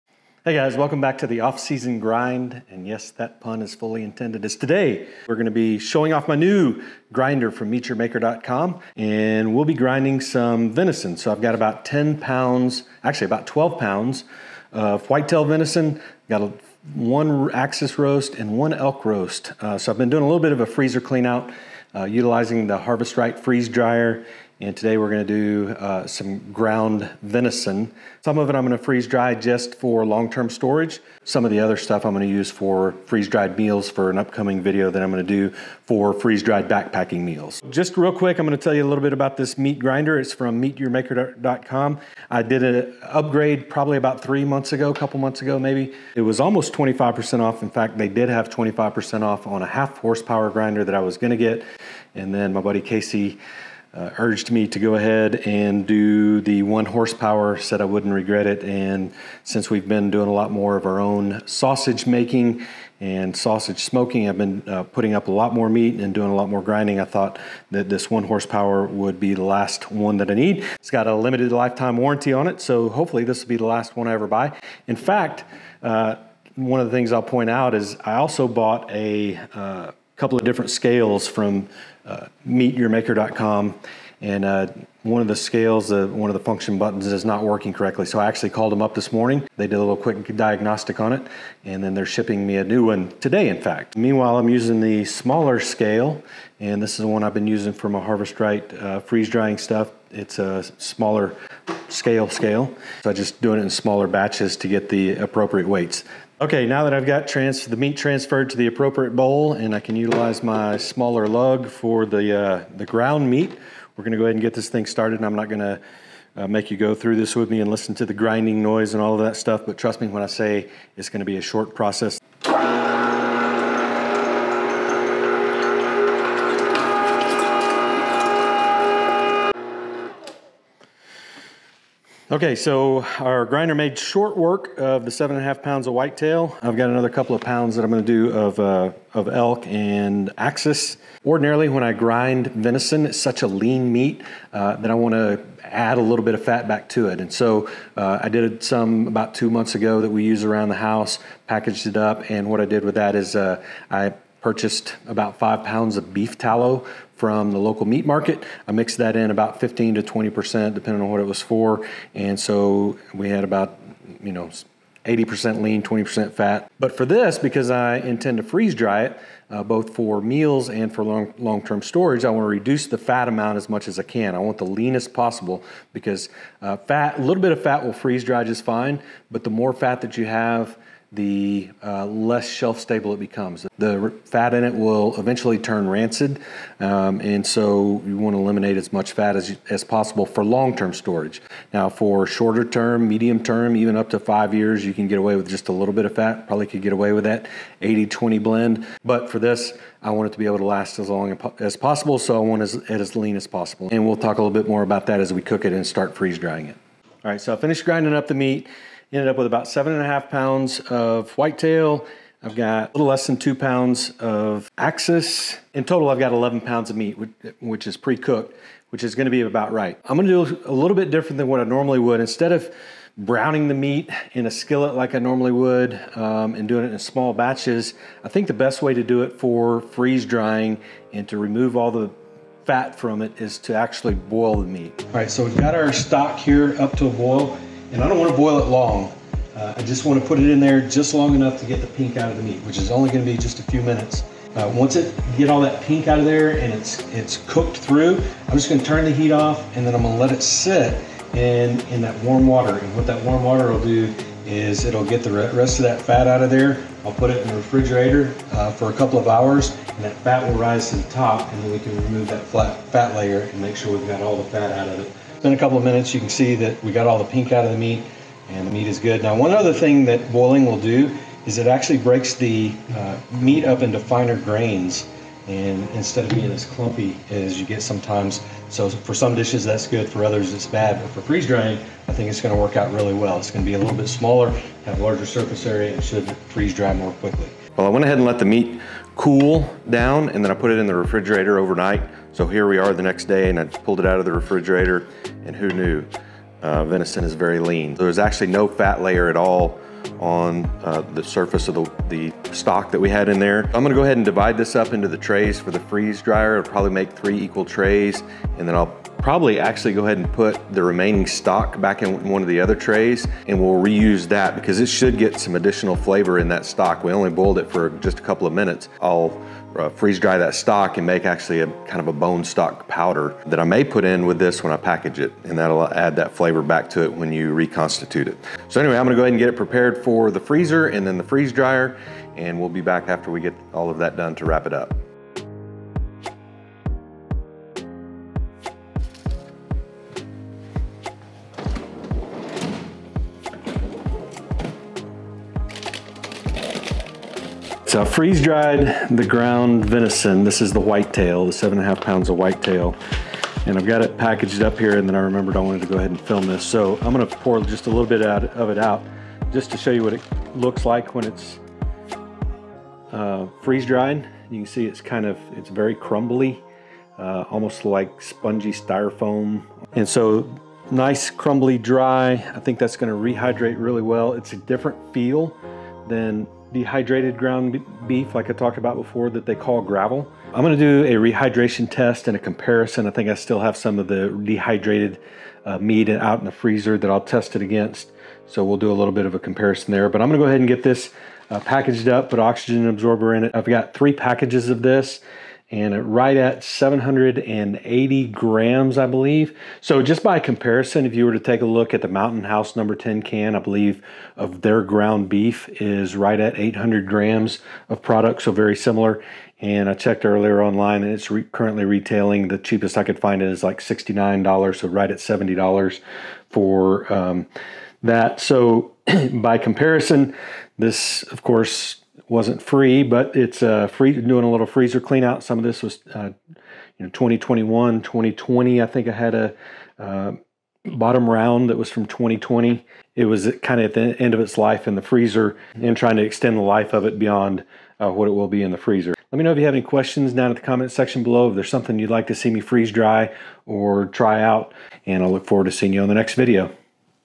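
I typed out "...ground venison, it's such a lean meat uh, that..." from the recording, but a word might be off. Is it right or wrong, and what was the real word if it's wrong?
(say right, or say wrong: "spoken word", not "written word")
wrong: "grind", not "ground".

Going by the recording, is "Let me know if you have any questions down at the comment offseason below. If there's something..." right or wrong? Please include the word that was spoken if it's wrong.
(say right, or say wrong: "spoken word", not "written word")
wrong: "section", not "offseason".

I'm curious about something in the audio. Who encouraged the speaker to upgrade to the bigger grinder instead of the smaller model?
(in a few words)
Casey.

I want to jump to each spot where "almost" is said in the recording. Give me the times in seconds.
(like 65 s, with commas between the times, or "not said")
46 s, 367 s.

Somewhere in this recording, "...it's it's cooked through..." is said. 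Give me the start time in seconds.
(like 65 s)
246 s.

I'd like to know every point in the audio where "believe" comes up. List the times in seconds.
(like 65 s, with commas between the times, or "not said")
399 s, 403 s.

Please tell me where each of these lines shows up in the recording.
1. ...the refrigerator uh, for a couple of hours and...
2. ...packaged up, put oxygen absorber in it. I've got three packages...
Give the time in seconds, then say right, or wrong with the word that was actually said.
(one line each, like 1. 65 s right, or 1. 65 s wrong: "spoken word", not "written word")
1. 257 s right
2. 391 s right.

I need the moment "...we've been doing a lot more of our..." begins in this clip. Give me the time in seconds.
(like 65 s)
59 s.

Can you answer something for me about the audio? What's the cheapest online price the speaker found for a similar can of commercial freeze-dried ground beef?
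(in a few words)
$69.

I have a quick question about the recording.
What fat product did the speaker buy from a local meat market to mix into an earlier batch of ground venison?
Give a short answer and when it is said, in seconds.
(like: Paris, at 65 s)
beef tallow, at 156 s.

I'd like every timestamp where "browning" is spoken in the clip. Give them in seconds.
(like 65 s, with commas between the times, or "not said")
223 s.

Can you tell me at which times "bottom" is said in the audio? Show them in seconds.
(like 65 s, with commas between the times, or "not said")
430 s.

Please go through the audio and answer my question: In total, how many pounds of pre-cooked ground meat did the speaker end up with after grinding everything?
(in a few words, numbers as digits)
11 pounds.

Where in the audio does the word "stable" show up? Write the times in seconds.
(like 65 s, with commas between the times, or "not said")
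182 s.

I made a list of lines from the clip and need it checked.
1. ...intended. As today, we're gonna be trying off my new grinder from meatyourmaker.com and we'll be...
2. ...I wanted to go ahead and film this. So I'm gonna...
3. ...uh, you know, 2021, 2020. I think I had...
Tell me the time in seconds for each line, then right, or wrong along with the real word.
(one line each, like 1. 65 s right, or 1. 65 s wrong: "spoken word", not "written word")
1. 4 s wrong: "showing", not "trying"
2. 355 s right
3. 426 s right.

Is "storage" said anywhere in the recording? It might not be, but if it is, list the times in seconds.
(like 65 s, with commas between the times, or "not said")
30 s, 171 s, 190 s.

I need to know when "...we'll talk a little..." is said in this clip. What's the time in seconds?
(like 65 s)
204 s.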